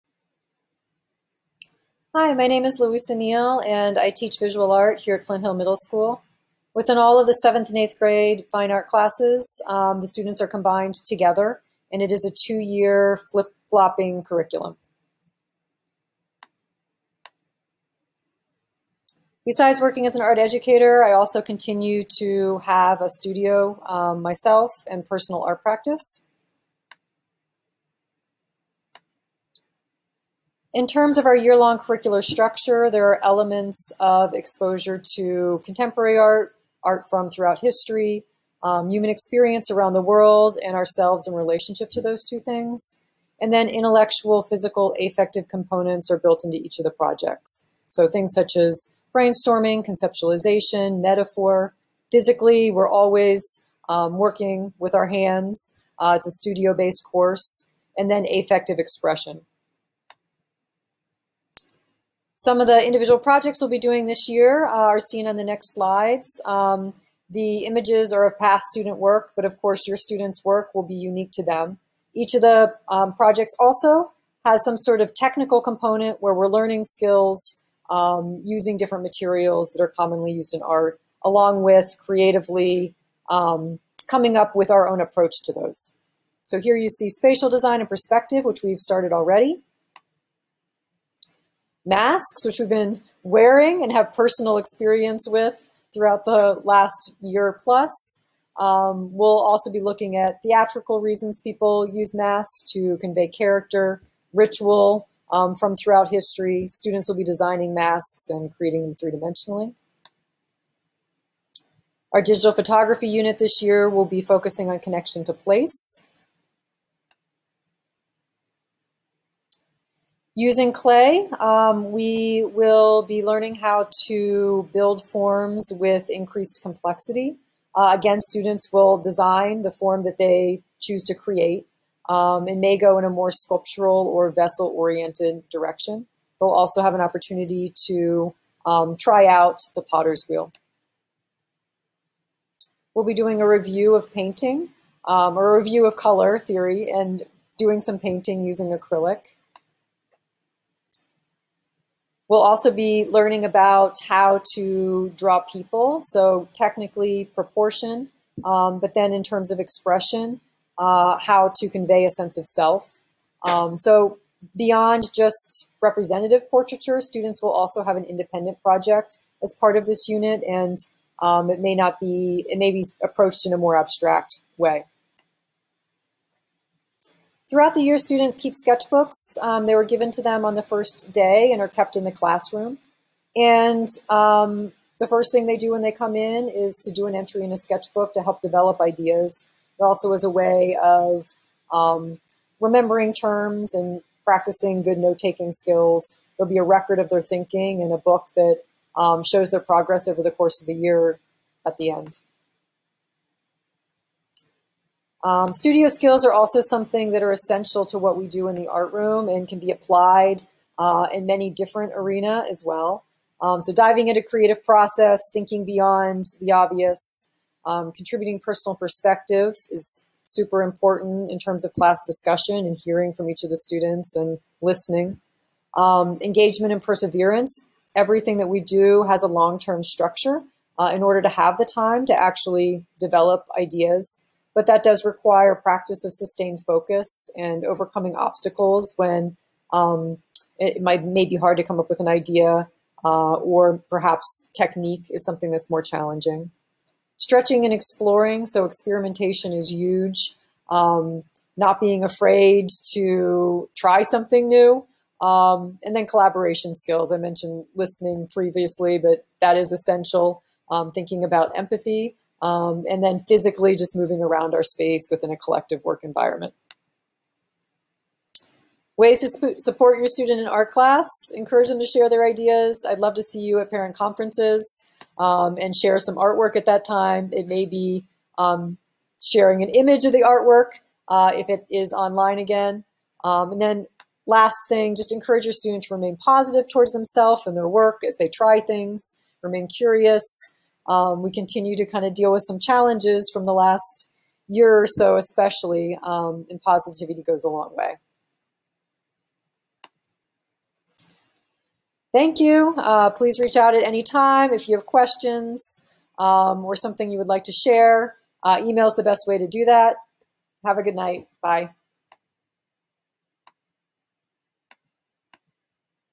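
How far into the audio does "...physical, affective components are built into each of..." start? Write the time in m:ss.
0:44.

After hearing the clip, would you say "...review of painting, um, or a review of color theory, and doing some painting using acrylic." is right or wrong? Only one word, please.
right.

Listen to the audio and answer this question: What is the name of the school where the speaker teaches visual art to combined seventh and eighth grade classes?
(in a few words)
Flint Hill Middle School.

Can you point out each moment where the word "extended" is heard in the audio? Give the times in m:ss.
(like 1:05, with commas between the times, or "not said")
not said.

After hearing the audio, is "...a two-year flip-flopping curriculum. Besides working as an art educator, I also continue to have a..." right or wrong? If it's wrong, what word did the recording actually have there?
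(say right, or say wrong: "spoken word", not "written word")
right.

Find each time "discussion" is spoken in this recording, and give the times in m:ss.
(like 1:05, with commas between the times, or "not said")
3:42.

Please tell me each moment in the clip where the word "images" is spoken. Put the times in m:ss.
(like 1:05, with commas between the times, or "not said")
1:07, 4:39.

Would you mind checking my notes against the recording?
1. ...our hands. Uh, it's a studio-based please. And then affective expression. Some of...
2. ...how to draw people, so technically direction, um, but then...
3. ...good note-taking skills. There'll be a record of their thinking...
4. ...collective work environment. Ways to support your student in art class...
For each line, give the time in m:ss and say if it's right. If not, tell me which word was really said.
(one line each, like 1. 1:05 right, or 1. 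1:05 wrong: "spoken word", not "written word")
1. 0:54 wrong: "course", not "please"
2. 2:34 wrong: "proportion", not "direction"
3. 3:14 right
4. 4:25 right.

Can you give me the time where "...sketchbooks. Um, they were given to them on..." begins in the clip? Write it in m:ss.
2:58.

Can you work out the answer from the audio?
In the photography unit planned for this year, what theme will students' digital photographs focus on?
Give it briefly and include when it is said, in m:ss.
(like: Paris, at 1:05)
Connection to place, at 1:54.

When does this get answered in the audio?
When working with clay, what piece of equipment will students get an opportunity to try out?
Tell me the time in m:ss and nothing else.
2:19.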